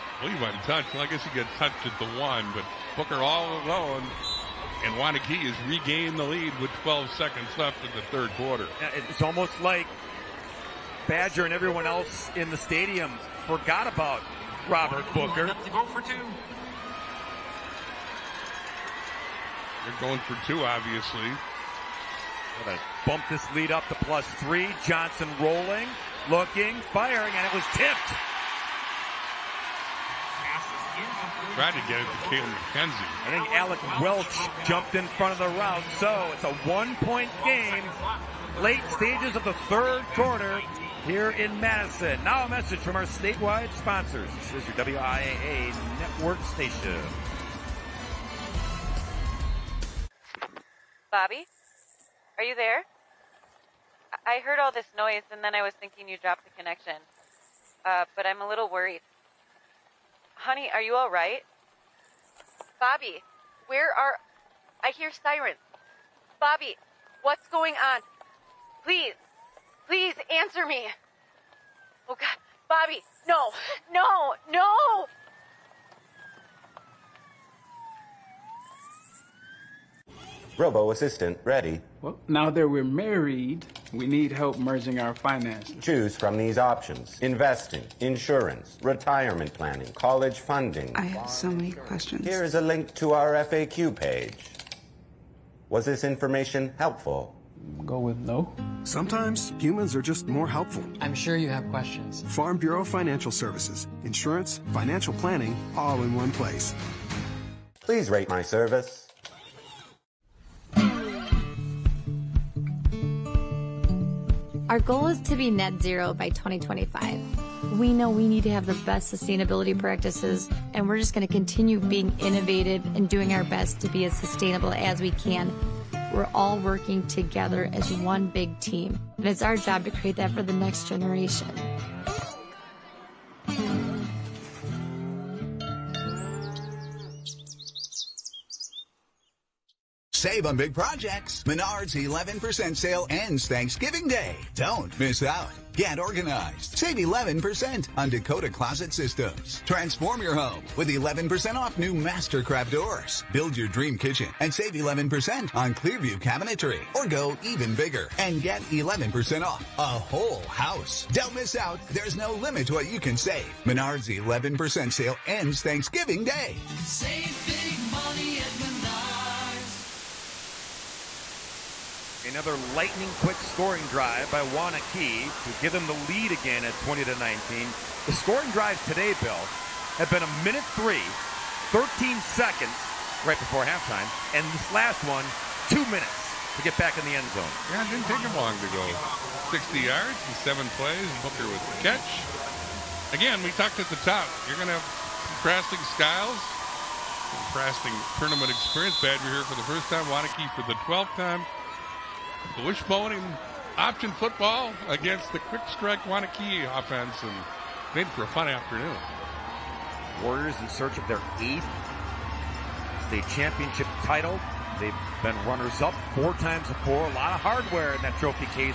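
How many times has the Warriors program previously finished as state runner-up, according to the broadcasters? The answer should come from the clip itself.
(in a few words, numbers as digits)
4.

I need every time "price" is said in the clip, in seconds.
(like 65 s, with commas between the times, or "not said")
not said.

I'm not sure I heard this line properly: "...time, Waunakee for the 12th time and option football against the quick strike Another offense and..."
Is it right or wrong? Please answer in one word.
wrong.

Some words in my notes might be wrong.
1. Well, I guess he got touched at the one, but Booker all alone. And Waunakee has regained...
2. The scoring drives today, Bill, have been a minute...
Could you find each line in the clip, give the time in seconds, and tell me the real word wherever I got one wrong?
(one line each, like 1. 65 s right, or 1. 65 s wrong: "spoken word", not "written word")
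1. 0 s right
2. 178 s right.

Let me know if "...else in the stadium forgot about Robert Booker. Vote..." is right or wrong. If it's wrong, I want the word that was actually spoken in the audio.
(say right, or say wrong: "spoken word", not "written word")
right.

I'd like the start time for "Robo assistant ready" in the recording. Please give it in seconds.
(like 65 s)
80 s.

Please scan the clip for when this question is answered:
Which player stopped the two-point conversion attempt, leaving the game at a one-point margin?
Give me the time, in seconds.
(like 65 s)
33 s.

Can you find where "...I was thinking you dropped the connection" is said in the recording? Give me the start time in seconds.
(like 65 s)
55 s.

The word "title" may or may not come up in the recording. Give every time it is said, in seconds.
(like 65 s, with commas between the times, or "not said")
214 s.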